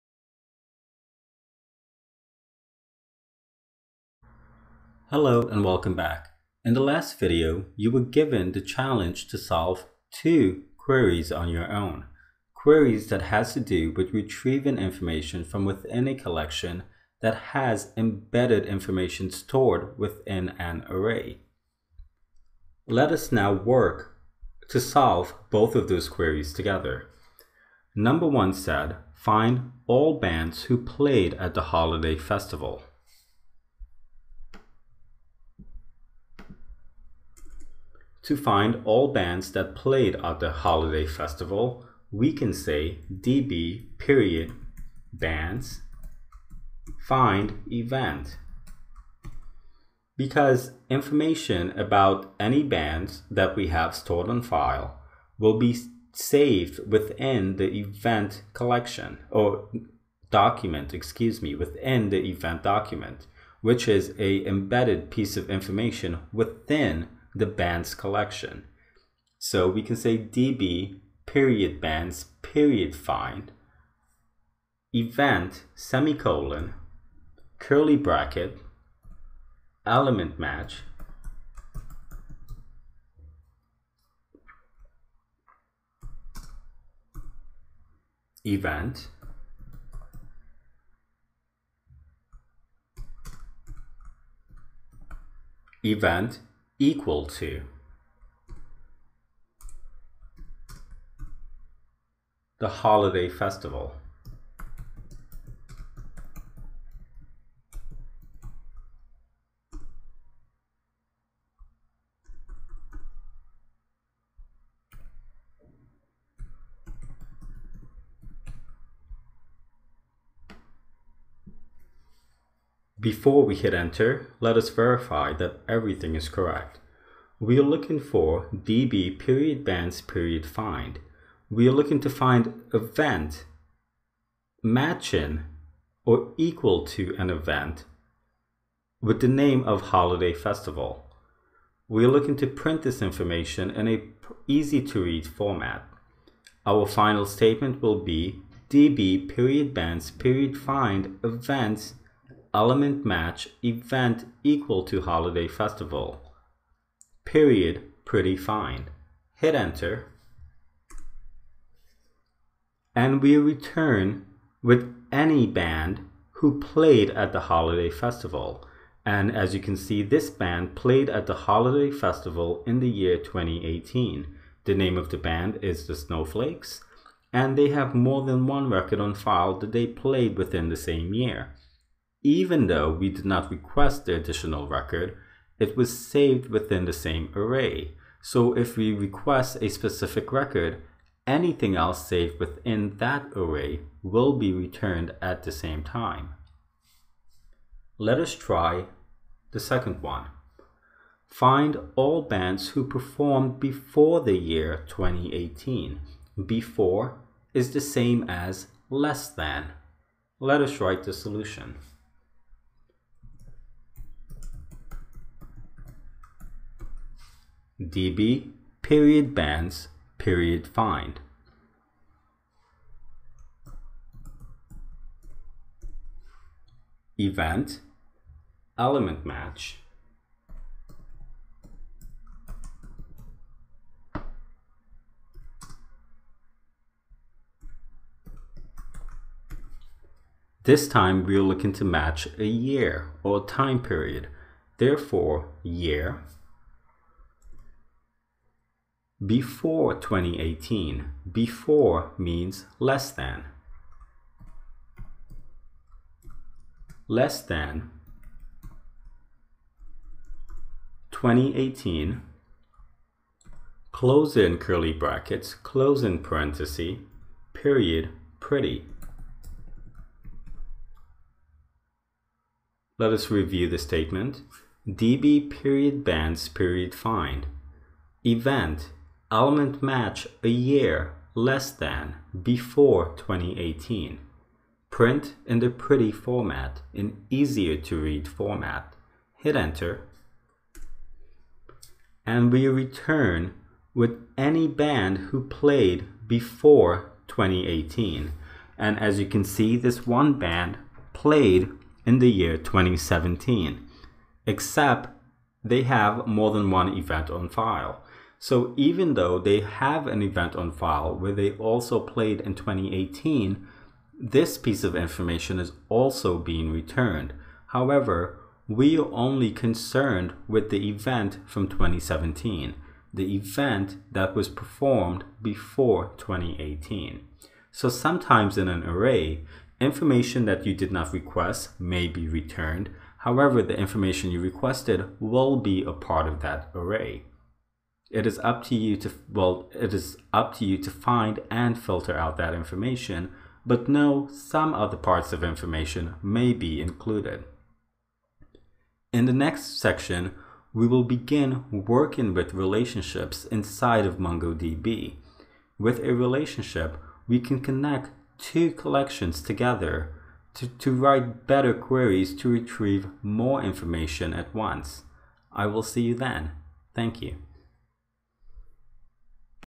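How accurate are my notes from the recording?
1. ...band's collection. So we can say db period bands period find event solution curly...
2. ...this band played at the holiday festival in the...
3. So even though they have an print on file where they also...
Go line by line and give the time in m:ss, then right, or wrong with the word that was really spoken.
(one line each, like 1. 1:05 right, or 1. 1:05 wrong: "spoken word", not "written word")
1. 1:07 wrong: "semicolon", not "solution"
2. 2:50 right
3. 5:08 wrong: "event", not "print".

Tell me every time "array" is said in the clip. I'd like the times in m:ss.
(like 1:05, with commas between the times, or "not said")
0:20, 3:07, 3:13, 5:28, 5:36.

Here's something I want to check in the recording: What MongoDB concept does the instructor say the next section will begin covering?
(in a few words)
Relationships.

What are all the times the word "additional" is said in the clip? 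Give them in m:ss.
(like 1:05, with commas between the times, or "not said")
3:04.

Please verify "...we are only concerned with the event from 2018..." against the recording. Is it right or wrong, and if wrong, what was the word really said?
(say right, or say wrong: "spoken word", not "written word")
wrong: "2017", not "2018".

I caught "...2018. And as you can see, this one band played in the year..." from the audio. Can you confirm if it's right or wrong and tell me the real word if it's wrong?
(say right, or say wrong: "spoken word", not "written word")
right.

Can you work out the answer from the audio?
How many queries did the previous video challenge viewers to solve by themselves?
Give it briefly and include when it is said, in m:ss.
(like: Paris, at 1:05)
2, at 0:10.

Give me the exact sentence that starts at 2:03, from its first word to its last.
Before we hit enter, let us verify that everything is correct.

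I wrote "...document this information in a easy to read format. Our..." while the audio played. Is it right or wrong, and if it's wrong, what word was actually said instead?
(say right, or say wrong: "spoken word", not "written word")
wrong: "print", not "document".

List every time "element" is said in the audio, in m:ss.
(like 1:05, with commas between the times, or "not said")
1:19, 2:32, 3:48, 4:39.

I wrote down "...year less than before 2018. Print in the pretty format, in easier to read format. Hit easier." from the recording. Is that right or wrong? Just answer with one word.
wrong.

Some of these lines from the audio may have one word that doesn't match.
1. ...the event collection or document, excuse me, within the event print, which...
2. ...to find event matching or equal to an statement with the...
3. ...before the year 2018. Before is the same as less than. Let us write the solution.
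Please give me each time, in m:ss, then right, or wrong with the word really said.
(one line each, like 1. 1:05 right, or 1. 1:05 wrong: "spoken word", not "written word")
1. 0:57 wrong: "document", not "print"
2. 2:12 wrong: "event", not "statement"
3. 3:23 right.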